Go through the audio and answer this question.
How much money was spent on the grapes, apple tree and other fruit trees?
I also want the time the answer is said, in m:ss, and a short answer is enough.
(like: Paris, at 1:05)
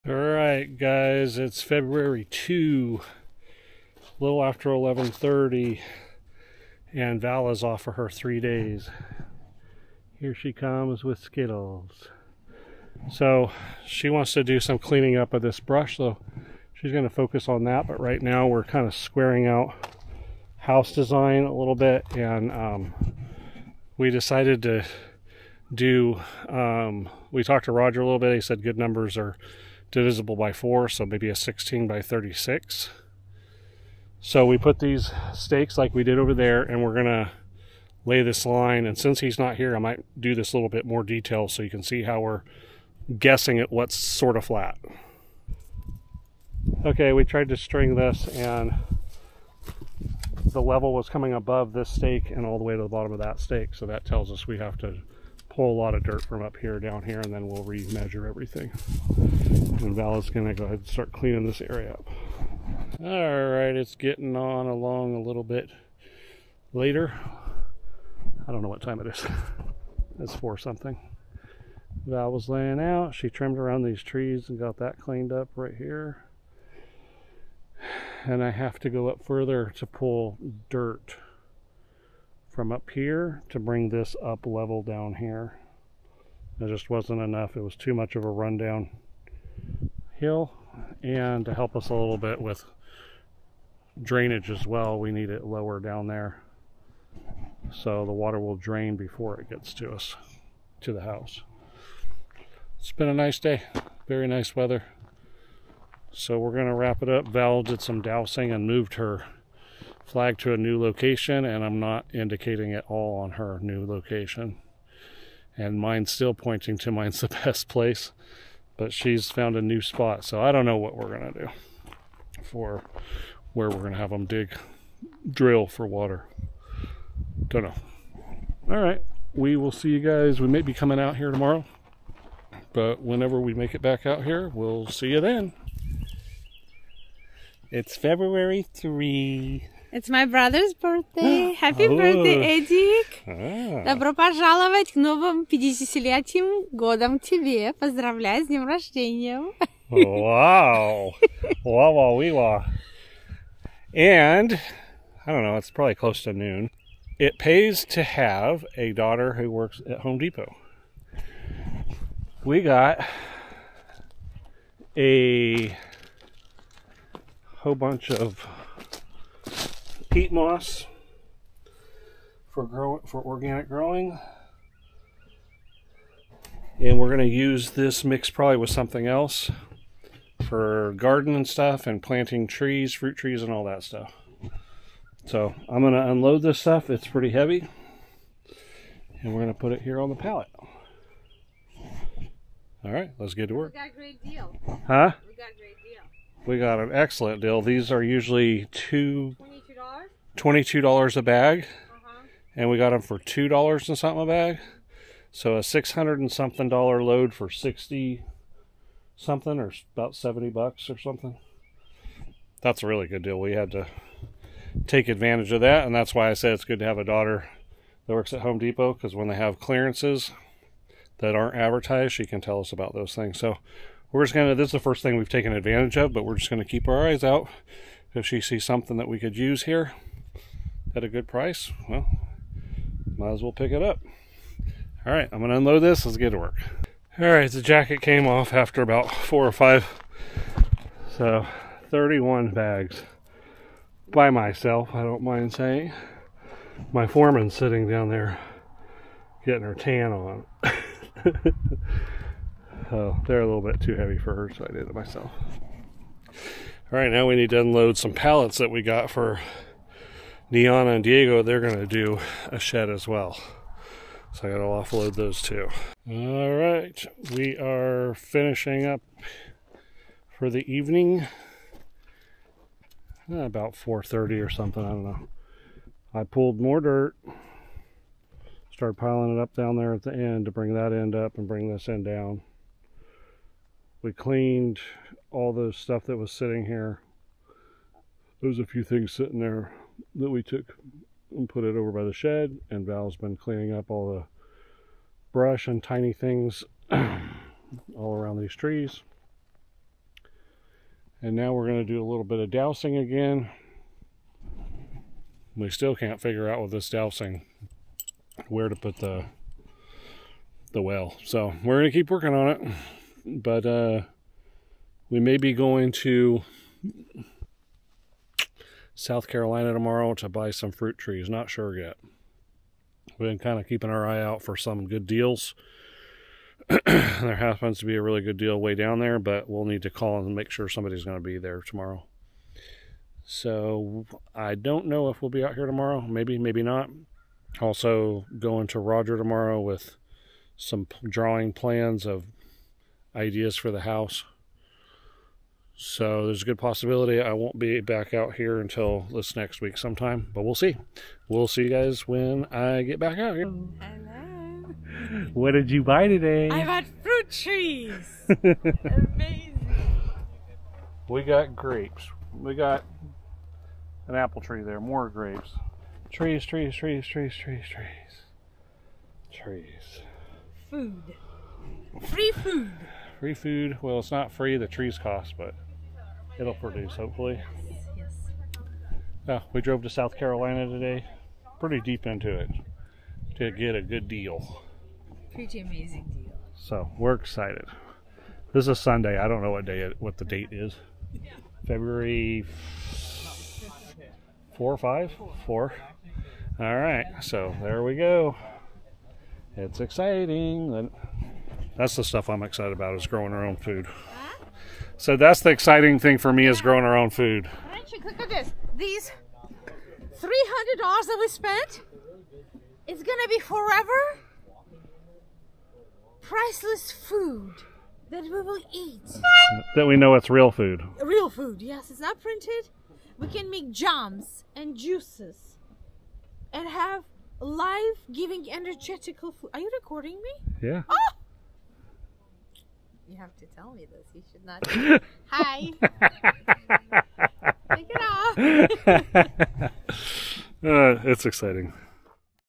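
$300, at 6:49.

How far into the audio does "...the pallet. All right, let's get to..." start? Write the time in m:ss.
3:10.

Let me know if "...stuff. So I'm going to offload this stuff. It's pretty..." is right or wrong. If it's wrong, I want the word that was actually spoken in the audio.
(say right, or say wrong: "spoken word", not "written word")
wrong: "unload", not "offload".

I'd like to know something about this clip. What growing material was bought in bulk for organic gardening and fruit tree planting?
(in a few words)
peat moss.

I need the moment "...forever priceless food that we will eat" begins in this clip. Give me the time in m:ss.
6:53.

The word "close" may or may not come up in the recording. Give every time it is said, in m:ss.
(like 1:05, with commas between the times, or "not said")
2:35.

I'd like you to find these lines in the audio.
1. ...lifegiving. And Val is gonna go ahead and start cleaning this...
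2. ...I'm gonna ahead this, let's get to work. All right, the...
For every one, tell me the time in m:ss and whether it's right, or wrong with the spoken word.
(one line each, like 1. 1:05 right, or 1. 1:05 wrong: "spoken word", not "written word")
1. 0:58 wrong: "everything", not "lifegiving"
2. 3:55 wrong: "unload", not "ahead".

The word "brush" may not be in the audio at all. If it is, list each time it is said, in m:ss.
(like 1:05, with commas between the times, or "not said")
0:15, 4:55.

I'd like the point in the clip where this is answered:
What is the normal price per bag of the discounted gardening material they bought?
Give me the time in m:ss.
3:20.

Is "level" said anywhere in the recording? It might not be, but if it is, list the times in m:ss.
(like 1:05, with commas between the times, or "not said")
0:50, 1:24.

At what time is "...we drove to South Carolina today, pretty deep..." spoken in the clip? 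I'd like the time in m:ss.
6:19.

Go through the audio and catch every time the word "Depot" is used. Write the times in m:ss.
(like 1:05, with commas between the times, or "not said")
2:40, 3:38.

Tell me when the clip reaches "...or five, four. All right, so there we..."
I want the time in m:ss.
6:34.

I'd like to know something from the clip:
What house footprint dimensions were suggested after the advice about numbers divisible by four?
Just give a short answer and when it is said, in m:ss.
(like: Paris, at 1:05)
16 by 36, at 0:31.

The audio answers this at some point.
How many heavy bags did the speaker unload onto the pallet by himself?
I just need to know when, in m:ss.
4:01.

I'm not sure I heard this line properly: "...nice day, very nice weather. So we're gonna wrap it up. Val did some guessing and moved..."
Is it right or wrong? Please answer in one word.
wrong.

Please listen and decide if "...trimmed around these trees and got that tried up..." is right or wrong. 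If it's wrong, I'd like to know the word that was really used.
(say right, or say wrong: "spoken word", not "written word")
wrong: "cleaned", not "tried".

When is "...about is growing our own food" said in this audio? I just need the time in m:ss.
6:42.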